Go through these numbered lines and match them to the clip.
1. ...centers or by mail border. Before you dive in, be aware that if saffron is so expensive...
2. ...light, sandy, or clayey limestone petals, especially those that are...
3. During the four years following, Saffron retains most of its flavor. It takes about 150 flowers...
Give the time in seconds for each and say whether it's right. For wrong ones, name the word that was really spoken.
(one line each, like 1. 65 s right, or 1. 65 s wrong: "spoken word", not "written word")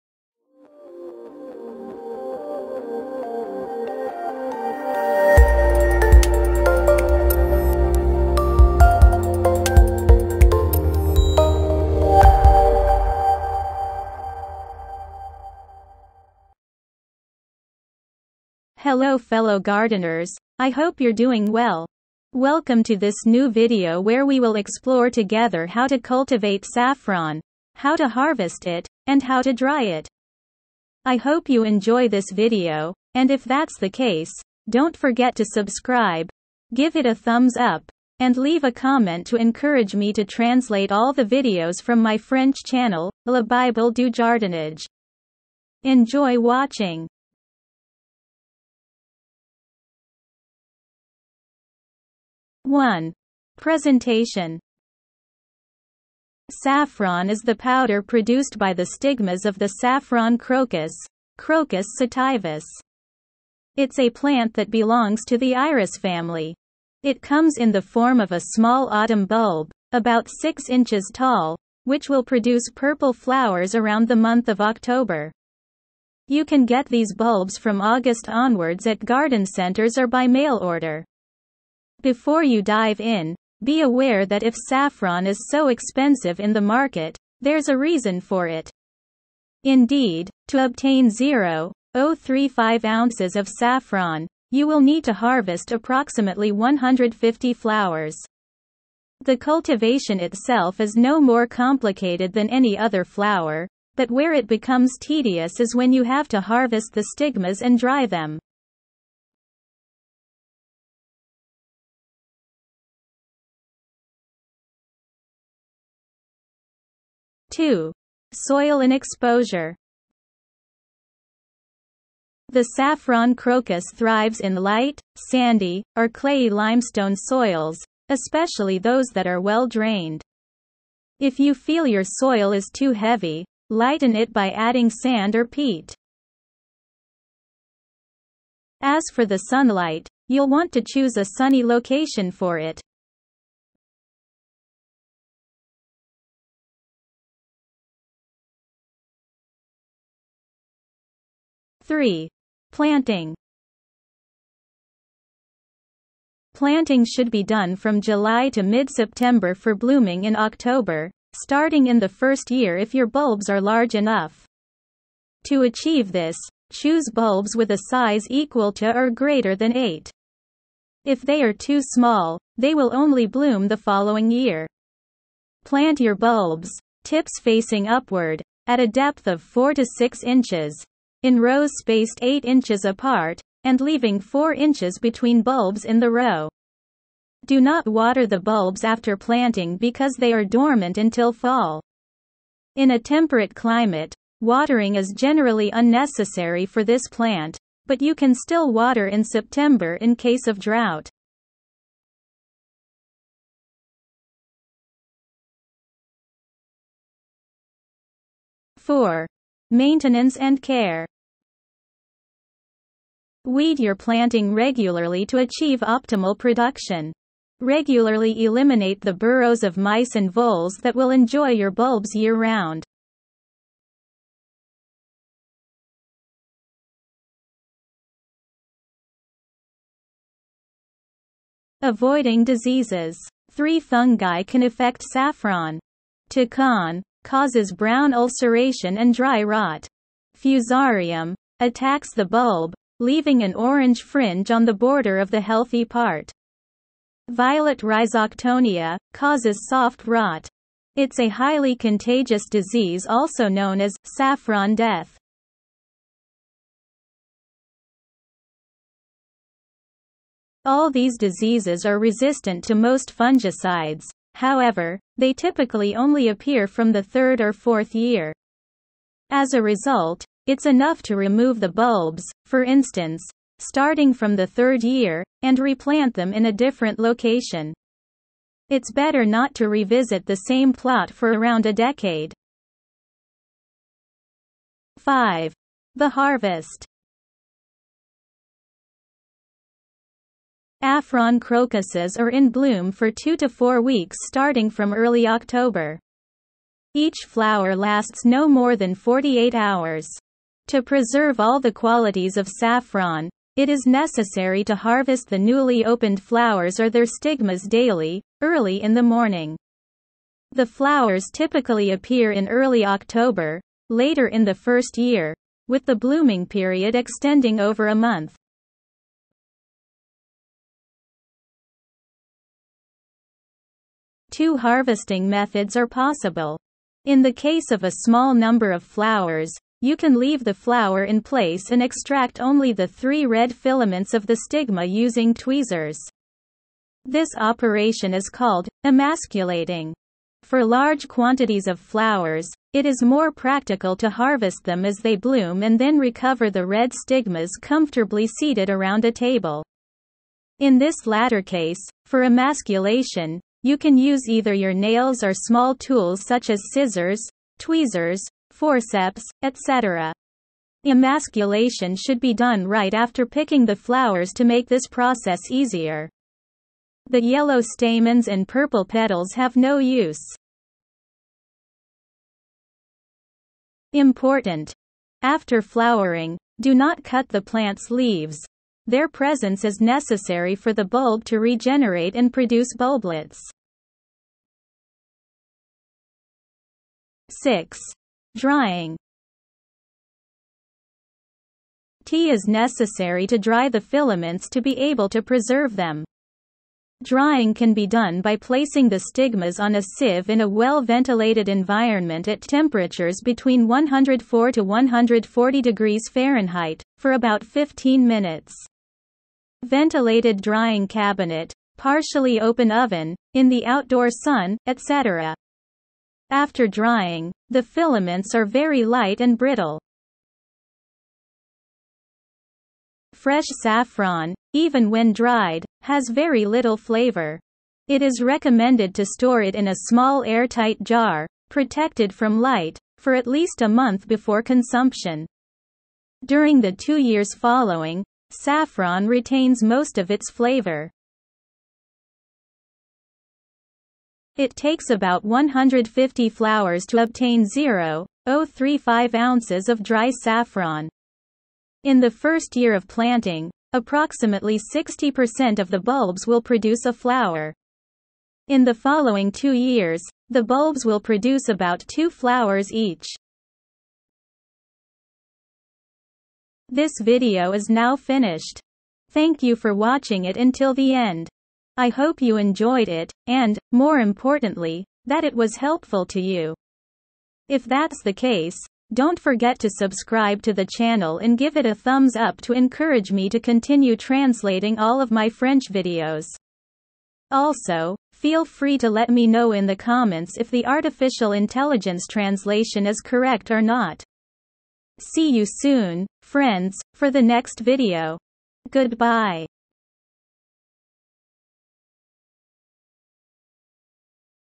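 1. 79 s wrong: "order", not "border"
2. 124 s wrong: "soils", not "petals"
3. 436 s wrong: "two", not "four".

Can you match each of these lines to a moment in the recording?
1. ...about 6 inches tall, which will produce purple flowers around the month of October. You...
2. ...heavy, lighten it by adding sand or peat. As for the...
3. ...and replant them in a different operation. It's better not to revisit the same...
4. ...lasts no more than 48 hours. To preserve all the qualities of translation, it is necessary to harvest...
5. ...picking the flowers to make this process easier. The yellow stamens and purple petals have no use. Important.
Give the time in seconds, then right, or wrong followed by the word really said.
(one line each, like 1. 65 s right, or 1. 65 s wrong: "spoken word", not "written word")
1. 69 s right
2. 132 s right
3. 275 s wrong: "location", not "operation"
4. 297 s wrong: "saffron", not "translation"
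5. 363 s right.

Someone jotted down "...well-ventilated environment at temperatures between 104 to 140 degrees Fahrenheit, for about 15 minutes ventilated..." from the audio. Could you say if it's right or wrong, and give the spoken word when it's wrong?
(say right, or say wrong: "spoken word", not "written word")
right.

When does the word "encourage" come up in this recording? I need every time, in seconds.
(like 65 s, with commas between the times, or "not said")
39 s, 482 s.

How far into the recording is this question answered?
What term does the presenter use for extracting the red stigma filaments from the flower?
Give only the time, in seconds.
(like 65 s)
338 s.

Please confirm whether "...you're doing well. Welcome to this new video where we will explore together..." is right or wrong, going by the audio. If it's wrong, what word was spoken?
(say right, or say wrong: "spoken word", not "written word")
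right.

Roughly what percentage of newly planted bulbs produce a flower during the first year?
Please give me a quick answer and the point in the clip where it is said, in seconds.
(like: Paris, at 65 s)
60%, at 454 s.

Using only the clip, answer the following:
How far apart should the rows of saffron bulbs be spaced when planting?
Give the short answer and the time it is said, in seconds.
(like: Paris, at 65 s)
8 inches, at 182 s.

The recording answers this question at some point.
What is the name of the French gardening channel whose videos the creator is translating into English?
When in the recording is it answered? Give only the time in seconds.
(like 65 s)
43 s.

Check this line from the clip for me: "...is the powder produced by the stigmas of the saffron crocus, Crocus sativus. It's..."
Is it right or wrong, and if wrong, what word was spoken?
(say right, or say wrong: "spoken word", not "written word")
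right.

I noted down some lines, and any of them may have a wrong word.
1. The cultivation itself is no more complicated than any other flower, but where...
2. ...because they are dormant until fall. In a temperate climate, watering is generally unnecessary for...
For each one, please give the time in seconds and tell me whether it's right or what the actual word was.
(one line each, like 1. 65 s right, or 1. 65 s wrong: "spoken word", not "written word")
1. 99 s right
2. 189 s right.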